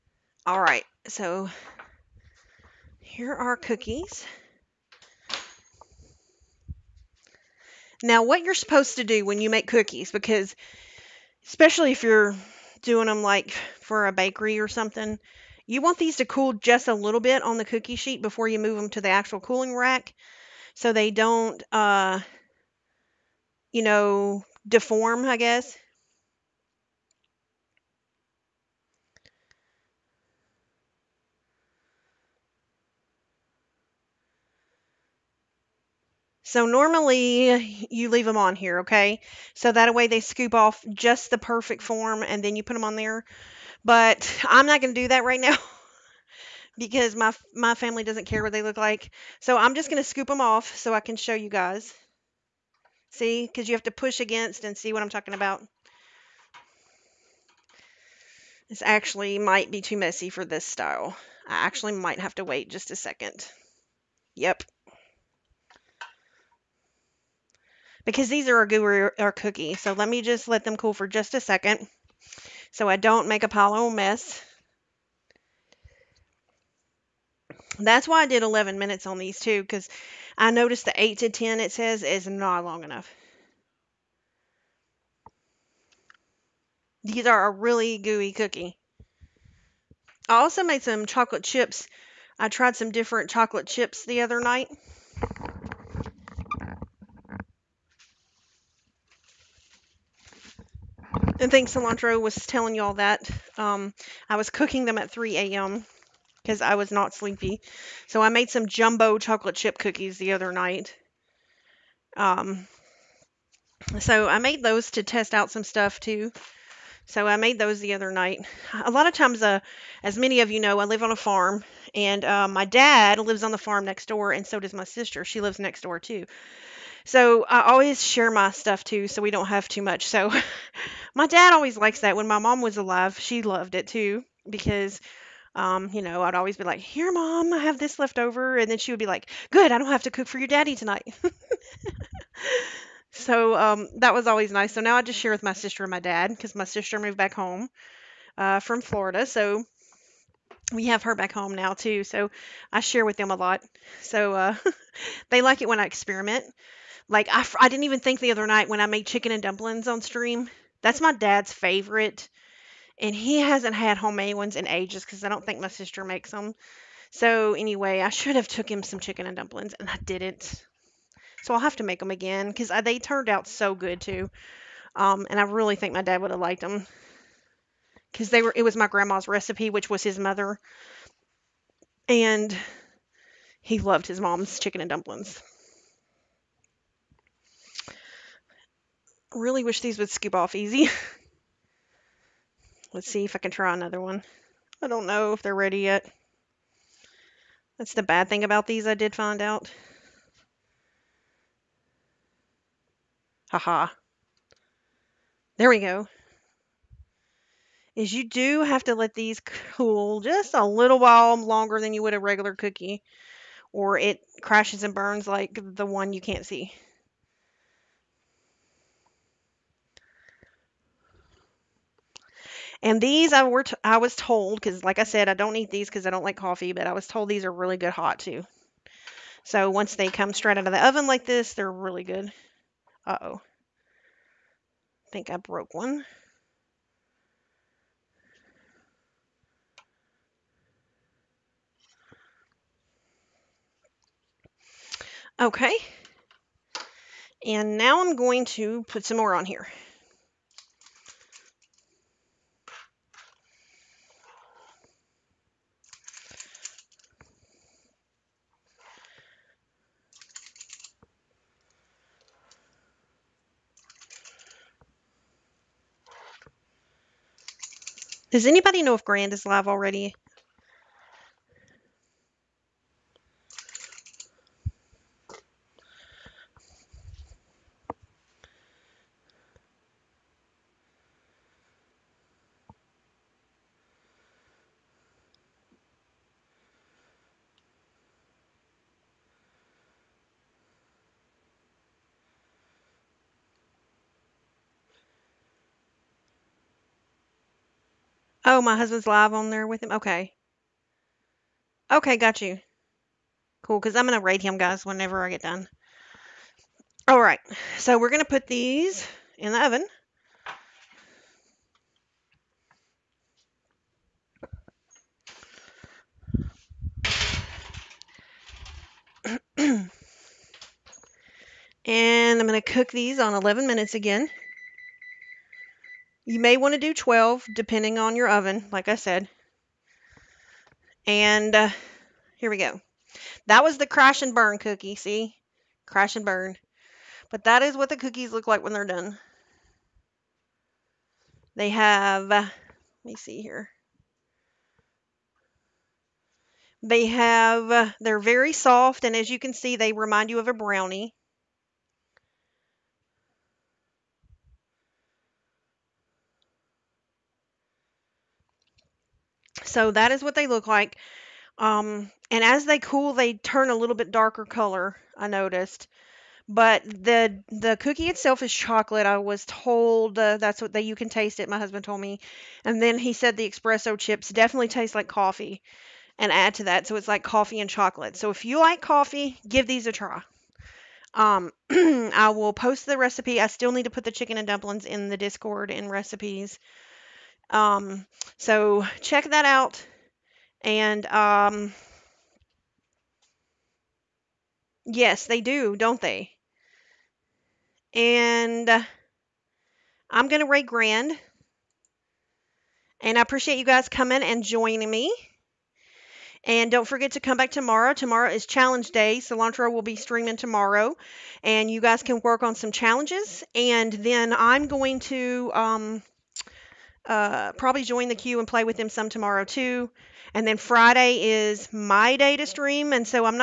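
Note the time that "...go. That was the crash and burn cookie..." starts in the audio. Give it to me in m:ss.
5:32.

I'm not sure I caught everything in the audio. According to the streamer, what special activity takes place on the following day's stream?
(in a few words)
challenge day.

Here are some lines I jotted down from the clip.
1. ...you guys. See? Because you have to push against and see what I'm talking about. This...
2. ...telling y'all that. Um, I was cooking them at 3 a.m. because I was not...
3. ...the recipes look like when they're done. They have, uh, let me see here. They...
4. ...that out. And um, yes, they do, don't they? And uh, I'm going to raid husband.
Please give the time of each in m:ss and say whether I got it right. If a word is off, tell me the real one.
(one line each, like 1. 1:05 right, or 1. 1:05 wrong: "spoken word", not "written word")
1. 0:51 right
2. 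1:42 right
3. 5:37 wrong: "cookies", not "recipes"
4. 6:29 wrong: "grand", not "husband".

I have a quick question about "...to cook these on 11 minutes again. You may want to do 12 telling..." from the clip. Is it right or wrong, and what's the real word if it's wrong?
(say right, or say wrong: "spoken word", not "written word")
wrong: "depending", not "telling".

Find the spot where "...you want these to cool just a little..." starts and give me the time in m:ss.
0:15.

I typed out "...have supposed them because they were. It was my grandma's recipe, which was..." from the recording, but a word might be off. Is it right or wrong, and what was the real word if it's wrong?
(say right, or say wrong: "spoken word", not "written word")
wrong: "liked", not "supposed".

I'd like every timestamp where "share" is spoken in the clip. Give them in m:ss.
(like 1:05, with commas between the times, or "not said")
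2:08, 2:25, 2:32.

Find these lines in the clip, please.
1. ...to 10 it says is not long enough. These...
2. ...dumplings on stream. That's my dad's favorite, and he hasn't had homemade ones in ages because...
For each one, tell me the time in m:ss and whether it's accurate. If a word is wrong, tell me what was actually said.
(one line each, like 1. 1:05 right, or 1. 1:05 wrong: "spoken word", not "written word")
1. 1:21 right
2. 2:39 right.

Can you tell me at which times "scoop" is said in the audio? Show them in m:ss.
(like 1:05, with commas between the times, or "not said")
0:40, 0:50, 3:10.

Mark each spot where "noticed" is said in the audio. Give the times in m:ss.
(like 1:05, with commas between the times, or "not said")
1:20, 6:05.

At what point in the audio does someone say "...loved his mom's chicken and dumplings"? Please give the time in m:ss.
3:03.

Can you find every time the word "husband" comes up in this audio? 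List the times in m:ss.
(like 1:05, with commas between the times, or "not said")
4:58, 6:11.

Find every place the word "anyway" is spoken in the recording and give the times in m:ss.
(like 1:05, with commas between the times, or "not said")
2:47.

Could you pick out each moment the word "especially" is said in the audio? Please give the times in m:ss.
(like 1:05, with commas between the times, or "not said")
0:11.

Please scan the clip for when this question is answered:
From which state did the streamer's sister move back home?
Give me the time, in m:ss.
2:28.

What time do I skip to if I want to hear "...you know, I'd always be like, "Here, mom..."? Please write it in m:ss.
2:15.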